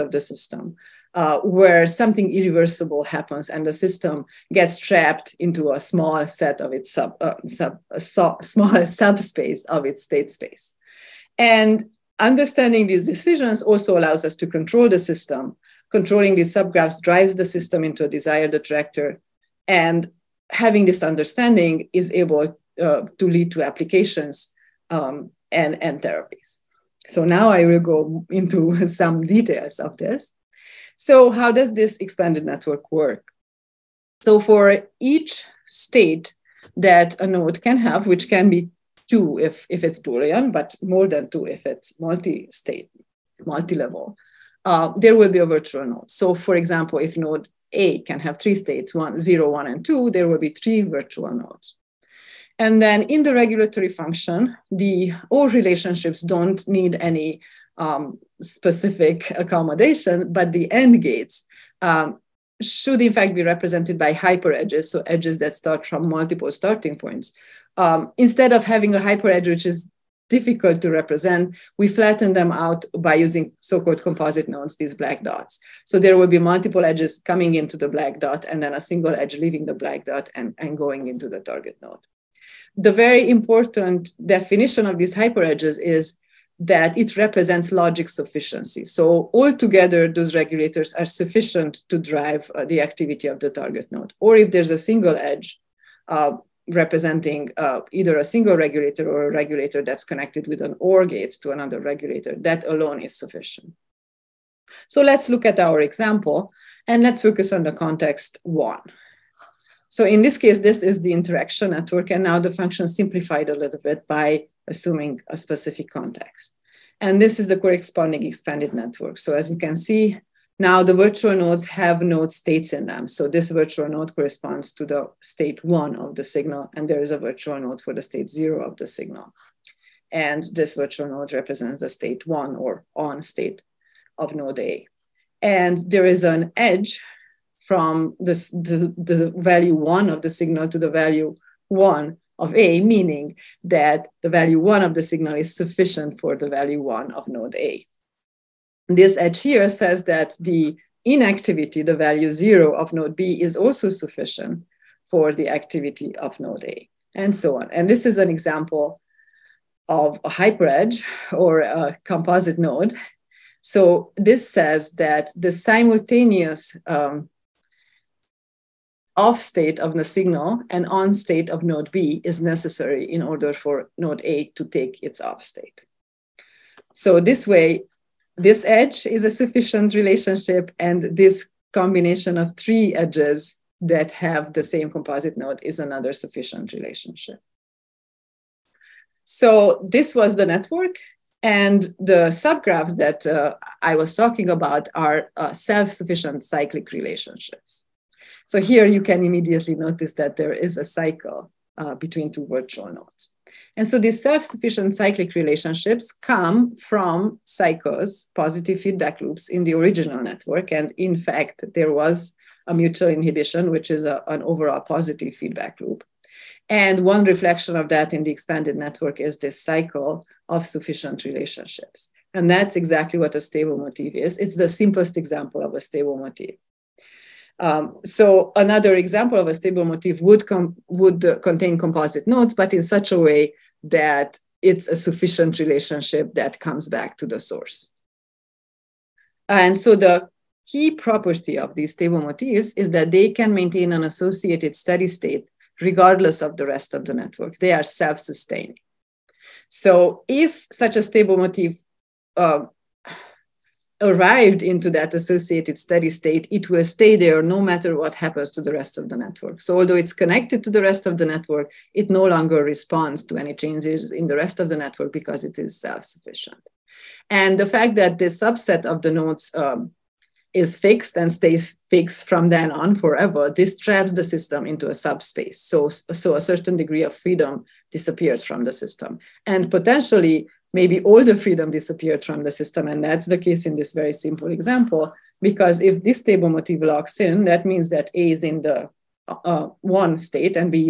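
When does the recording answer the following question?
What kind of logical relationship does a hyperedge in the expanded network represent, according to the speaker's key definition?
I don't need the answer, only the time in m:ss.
1:27.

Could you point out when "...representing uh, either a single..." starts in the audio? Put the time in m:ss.
1:36.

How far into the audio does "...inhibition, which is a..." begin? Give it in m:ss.
3:33.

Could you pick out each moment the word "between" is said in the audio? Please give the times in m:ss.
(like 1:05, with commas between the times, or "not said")
3:21.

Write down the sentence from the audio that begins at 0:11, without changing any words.
And Understanding these decisions also allows us to control the system.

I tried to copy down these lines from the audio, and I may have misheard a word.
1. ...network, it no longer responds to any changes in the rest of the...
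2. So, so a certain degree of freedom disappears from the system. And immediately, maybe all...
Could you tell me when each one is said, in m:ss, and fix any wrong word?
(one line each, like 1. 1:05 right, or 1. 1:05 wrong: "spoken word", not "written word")
1. 4:21 right
2. 4:35 wrong: "potentially", not "immediately".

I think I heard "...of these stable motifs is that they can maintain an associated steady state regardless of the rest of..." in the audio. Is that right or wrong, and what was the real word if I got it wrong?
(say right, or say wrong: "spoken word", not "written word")
right.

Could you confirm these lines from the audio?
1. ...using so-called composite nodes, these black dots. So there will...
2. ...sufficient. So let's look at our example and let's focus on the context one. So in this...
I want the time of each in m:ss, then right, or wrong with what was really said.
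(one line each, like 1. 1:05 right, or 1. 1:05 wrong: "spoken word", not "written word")
1. 1:13 right
2. 1:43 right.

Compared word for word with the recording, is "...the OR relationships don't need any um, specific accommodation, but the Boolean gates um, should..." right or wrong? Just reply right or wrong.
wrong.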